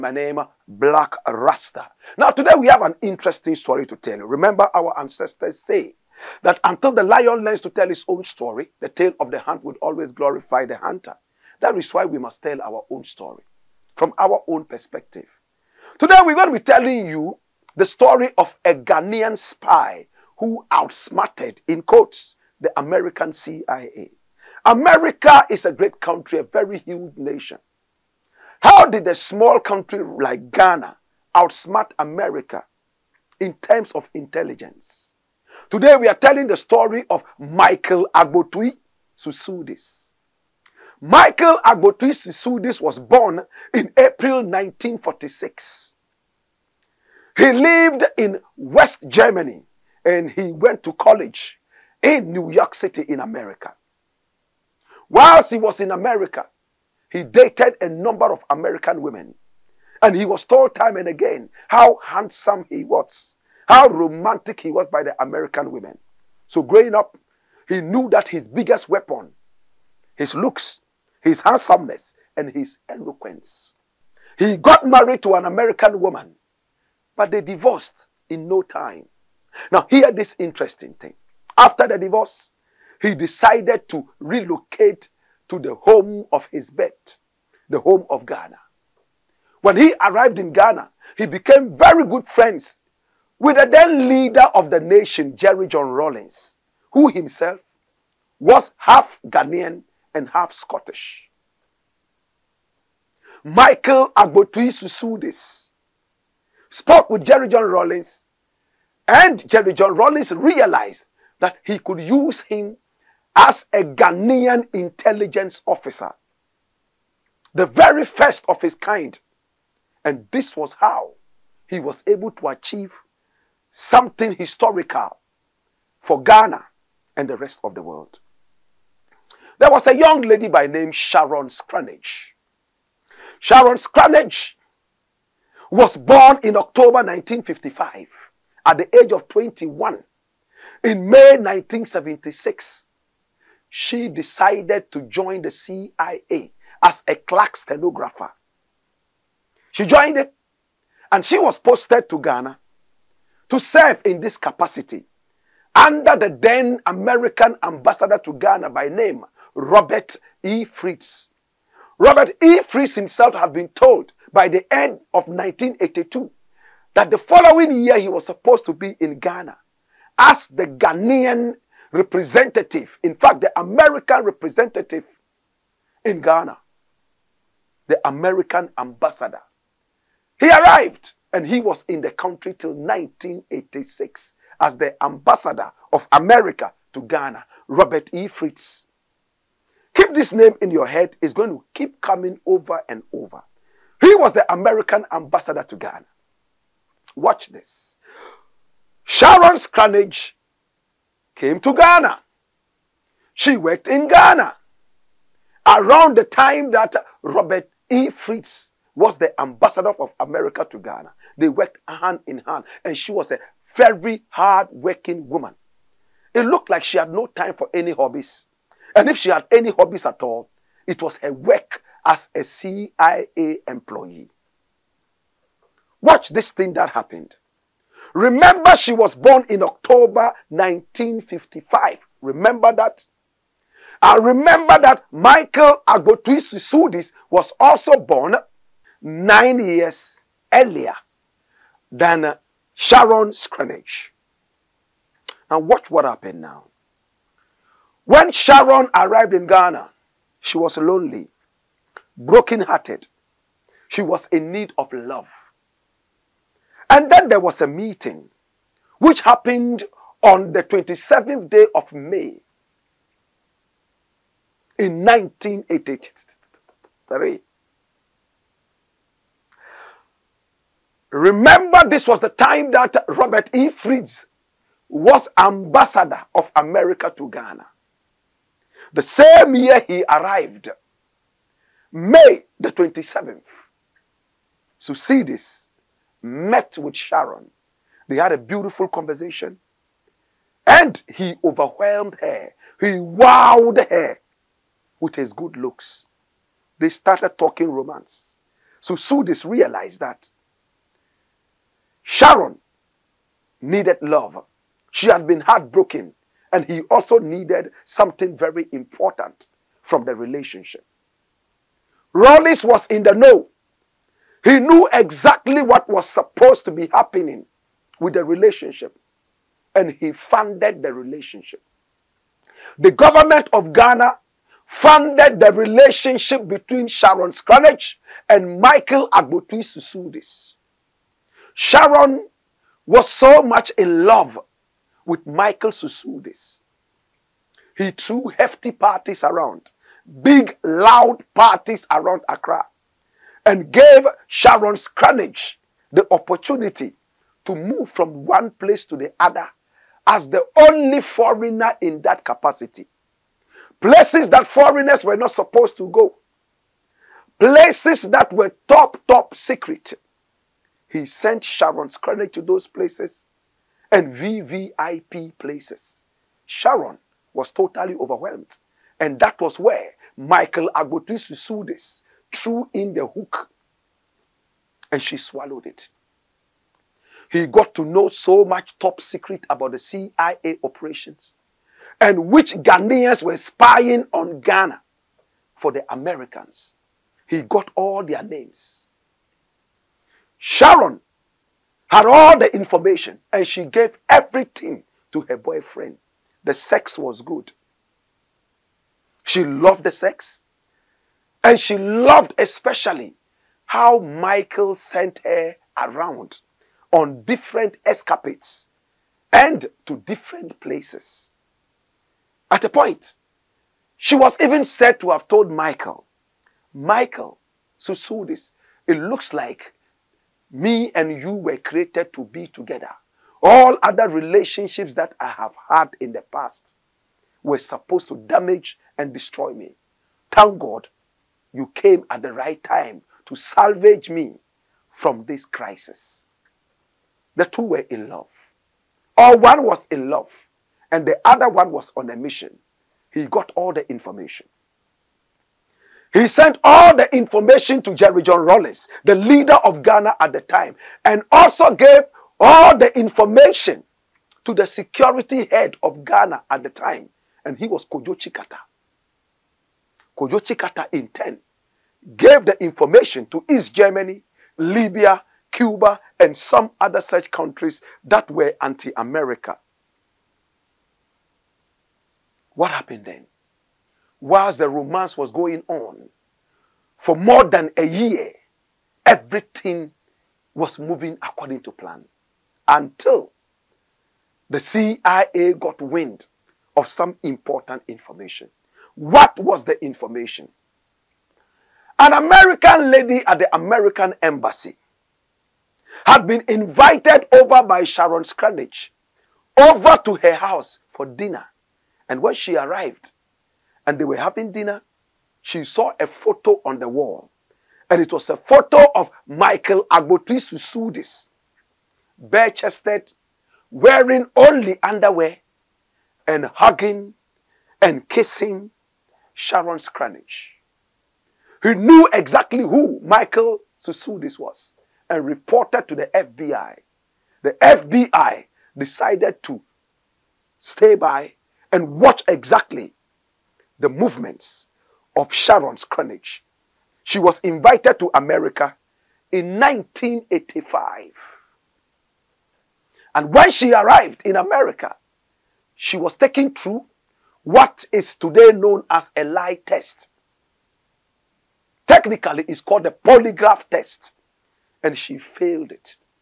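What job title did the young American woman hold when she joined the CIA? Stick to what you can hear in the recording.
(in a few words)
Clerk stenographer.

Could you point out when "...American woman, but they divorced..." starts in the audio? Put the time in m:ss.
1:15.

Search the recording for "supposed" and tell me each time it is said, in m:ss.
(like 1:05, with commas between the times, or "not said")
2:48, 5:16, 5:55, 7:07.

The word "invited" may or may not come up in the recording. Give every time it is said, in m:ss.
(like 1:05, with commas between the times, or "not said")
8:16, 8:57.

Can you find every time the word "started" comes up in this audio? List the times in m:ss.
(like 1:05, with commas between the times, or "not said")
4:56.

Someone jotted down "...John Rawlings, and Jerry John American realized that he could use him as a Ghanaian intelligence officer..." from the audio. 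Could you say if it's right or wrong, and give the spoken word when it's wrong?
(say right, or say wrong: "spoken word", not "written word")
wrong: "Rawlings", not "American".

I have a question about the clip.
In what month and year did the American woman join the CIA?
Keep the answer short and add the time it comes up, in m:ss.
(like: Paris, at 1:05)
May 1976, at 2:21.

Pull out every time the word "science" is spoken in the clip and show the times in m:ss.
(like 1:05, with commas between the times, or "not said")
not said.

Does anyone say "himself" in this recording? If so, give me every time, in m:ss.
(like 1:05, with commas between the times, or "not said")
1:37, 2:42.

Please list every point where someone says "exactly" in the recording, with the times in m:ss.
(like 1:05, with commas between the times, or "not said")
5:14, 8:42, 8:52.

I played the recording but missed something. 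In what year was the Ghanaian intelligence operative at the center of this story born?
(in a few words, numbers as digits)
1946.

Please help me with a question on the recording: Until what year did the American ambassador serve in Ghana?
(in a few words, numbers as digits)
1986.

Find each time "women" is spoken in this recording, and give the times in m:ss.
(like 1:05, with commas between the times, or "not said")
0:59, 1:05.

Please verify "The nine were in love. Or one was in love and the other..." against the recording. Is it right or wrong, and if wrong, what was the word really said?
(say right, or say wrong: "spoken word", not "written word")
wrong: "two", not "nine".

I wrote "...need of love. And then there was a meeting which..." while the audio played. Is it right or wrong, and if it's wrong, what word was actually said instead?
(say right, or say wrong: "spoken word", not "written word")
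right.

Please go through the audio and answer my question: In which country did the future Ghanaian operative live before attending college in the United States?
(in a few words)
West Germany.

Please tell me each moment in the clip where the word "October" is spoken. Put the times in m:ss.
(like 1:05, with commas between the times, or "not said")
2:16, 3:49.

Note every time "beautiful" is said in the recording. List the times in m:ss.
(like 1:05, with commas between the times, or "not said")
4:48.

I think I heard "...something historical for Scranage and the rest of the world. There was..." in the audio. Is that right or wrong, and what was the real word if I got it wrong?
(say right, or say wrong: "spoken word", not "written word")
wrong: "Ghana", not "Scranage".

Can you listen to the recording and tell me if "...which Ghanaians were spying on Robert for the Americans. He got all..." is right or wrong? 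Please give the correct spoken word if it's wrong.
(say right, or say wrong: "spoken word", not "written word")
wrong: "Ghana", not "Robert".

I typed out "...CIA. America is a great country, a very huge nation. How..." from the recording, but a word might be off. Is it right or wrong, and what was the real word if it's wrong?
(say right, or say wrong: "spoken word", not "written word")
right.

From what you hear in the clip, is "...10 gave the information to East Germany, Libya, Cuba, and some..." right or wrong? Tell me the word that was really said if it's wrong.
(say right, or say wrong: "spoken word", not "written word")
right.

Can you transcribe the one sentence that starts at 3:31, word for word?
They worked hand in hand, and she was a very hard working woman.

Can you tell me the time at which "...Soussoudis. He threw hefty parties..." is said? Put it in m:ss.
5:35.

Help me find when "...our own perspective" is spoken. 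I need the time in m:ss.
0:14.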